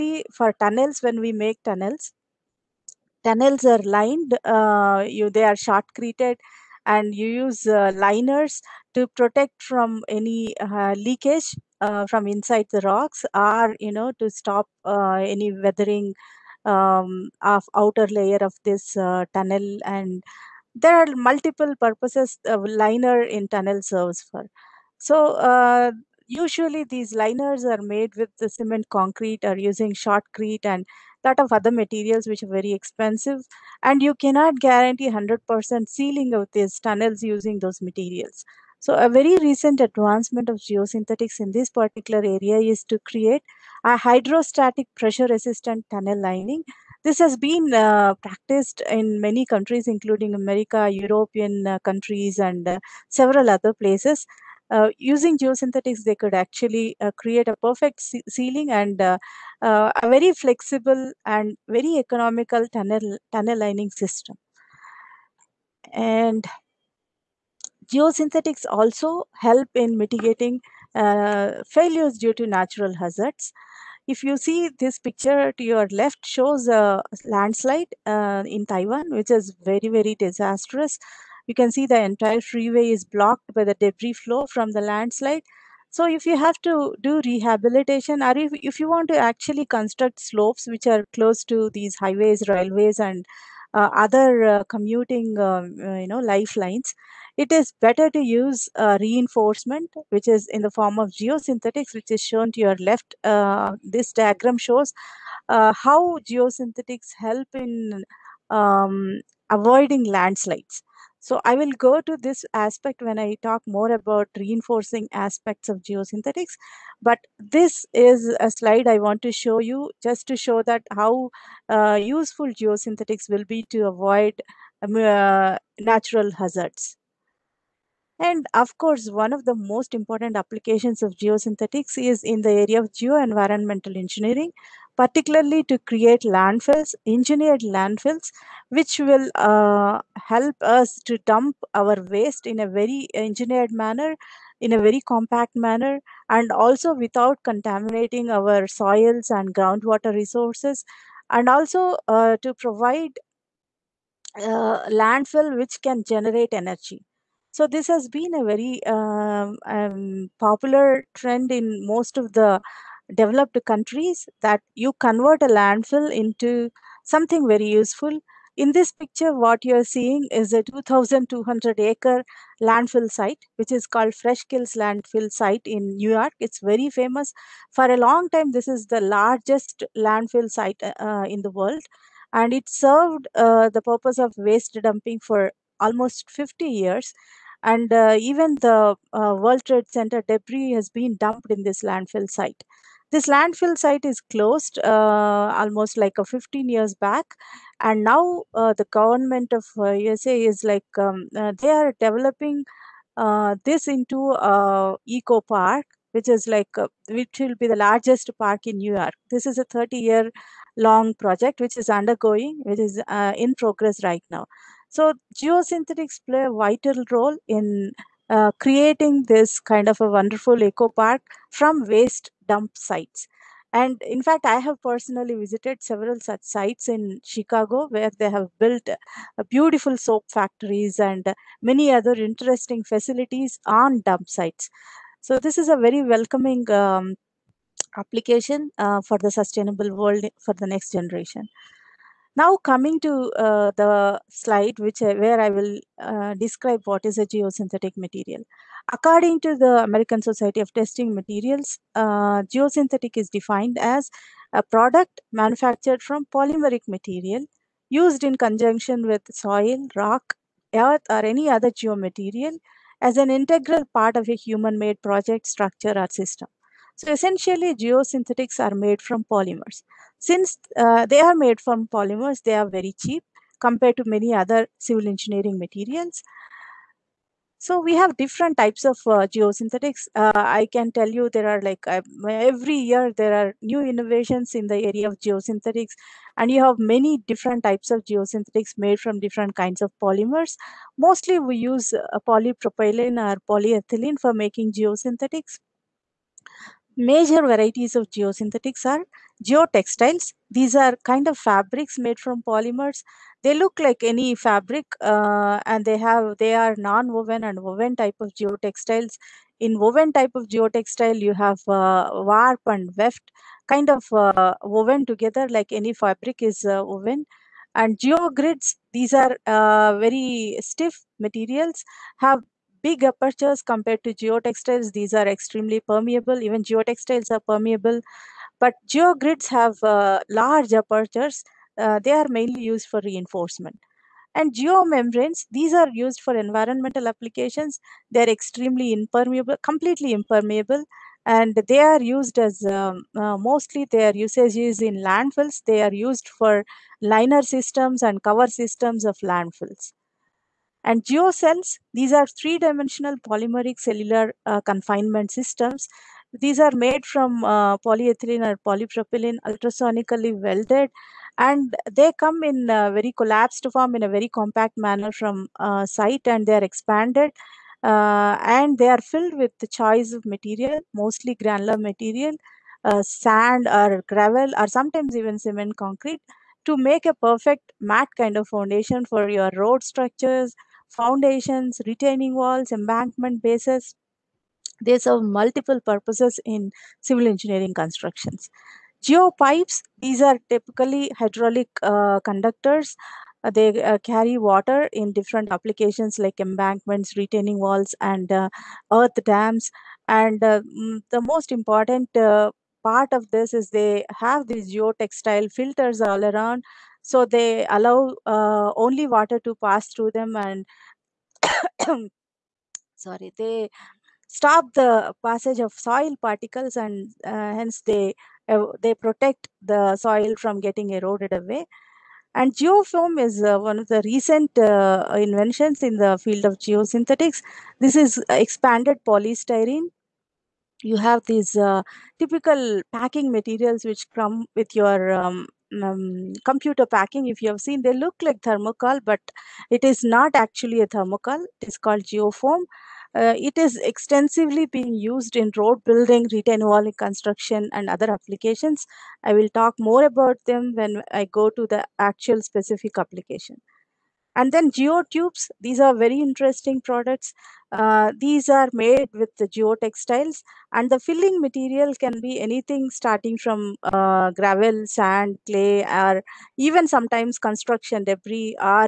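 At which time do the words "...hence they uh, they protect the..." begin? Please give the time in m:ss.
6:57.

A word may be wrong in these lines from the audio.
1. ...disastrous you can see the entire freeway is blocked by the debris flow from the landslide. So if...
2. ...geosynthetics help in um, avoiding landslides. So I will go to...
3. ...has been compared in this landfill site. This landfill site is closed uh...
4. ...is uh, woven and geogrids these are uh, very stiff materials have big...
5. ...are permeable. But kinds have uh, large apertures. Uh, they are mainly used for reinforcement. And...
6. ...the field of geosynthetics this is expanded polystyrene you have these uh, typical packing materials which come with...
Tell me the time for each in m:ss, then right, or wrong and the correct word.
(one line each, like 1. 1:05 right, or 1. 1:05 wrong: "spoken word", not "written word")
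1. 1:20 right
2. 1:46 right
3. 3:10 wrong: "dumped", not "compared"
4. 5:16 right
5. 5:27 wrong: "geogrids", not "kinds"
6. 7:06 right.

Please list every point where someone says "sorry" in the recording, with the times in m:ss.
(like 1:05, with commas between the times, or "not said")
6:53.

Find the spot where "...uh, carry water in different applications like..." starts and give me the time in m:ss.
6:33.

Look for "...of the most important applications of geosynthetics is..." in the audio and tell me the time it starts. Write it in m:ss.
2:09.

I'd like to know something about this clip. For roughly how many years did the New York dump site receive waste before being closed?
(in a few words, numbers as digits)
50 years.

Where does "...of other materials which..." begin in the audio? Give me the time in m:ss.
0:31.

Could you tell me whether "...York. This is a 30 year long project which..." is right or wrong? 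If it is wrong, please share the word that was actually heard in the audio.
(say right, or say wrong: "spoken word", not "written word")
right.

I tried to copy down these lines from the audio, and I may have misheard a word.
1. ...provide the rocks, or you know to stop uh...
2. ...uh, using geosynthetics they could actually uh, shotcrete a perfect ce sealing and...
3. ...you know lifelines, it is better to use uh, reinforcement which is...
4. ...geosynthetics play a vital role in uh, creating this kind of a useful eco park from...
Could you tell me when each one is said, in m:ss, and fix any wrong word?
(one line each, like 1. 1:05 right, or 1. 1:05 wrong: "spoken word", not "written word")
1. 0:12 wrong: "inside", not "provide"
2. 0:54 wrong: "create", not "shotcrete"
3. 1:35 right
4. 3:35 wrong: "wonderful", not "useful".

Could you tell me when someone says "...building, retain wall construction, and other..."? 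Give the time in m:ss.
7:25.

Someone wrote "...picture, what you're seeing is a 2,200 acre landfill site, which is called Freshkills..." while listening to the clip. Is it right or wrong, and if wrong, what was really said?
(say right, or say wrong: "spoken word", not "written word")
right.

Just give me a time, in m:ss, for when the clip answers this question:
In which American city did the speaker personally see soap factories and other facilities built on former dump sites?
3:47.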